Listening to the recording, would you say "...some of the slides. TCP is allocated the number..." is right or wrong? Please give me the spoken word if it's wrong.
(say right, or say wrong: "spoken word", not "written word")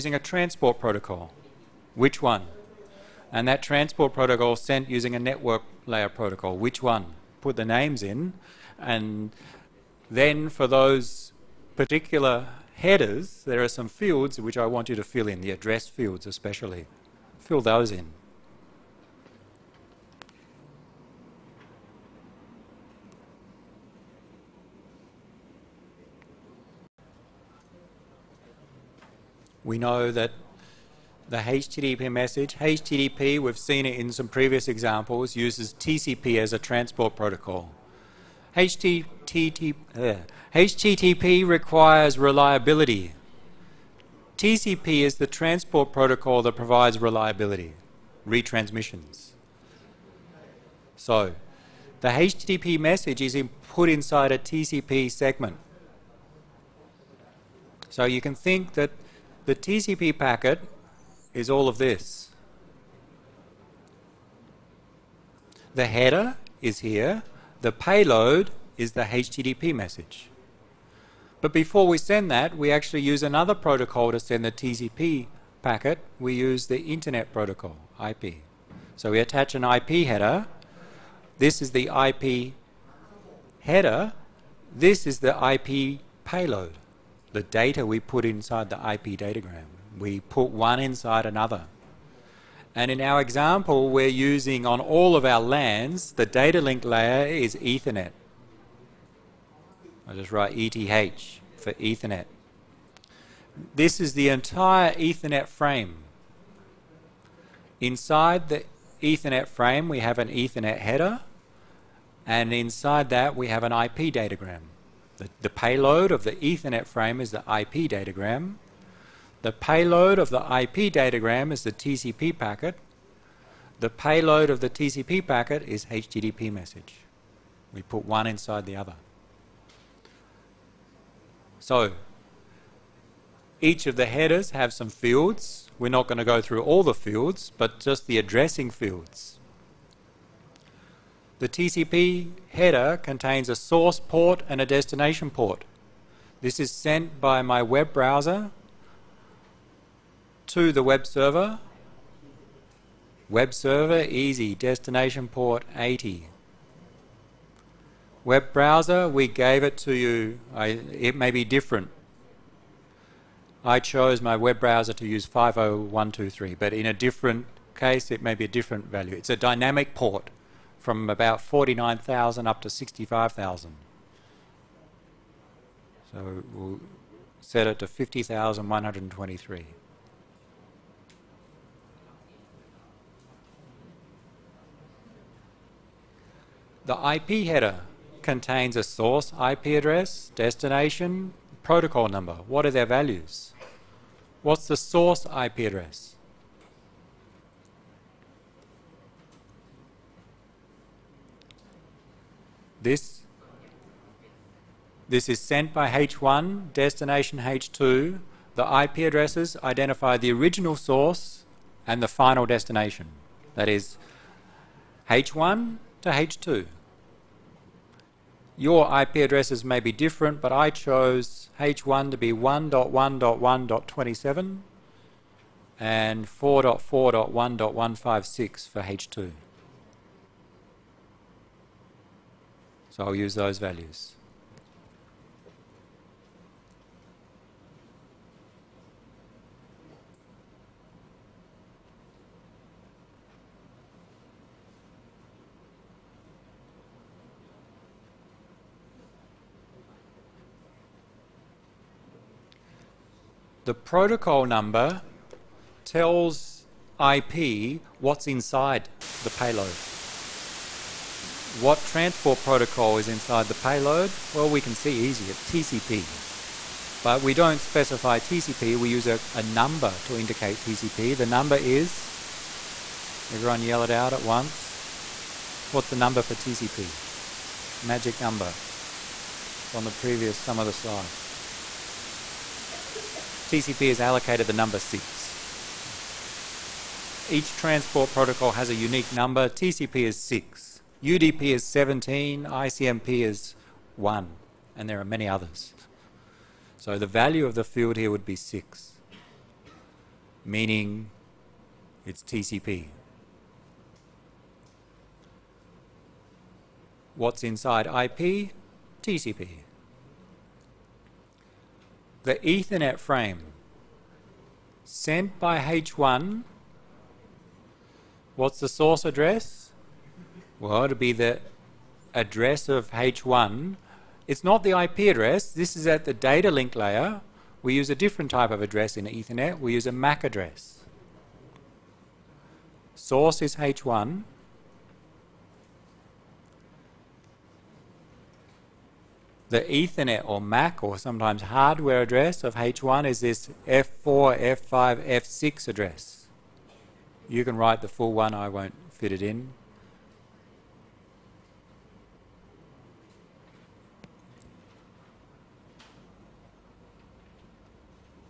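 right.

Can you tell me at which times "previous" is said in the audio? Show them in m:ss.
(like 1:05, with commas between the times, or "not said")
0:34, 4:39.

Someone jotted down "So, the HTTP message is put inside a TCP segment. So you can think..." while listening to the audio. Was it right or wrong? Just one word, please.
right.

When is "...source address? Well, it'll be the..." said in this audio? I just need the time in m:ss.
5:18.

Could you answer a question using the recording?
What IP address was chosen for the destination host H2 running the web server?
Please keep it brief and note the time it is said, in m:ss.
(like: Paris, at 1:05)
4.4.1.156, at 3:46.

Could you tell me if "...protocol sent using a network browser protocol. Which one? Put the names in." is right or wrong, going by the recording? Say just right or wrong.
wrong.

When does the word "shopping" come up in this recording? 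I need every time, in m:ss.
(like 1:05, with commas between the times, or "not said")
not said.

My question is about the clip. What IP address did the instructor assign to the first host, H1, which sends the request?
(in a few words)
1.1.1.27.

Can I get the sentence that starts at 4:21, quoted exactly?
What transport protocol is inside the payload?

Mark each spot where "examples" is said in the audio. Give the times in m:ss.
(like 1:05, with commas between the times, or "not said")
0:34, 1:33.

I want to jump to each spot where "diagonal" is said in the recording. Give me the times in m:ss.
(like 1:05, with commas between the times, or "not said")
not said.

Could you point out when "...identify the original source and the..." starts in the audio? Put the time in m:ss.
3:29.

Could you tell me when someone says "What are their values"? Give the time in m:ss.
3:12.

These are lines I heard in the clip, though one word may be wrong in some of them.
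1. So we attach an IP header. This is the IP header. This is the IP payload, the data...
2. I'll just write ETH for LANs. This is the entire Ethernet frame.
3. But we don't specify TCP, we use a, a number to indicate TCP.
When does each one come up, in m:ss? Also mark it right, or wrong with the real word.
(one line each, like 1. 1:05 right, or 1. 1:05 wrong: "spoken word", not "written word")
1. 1:18 right
2. 1:40 wrong: "Ethernet", not "LANs"
3. 4:27 right.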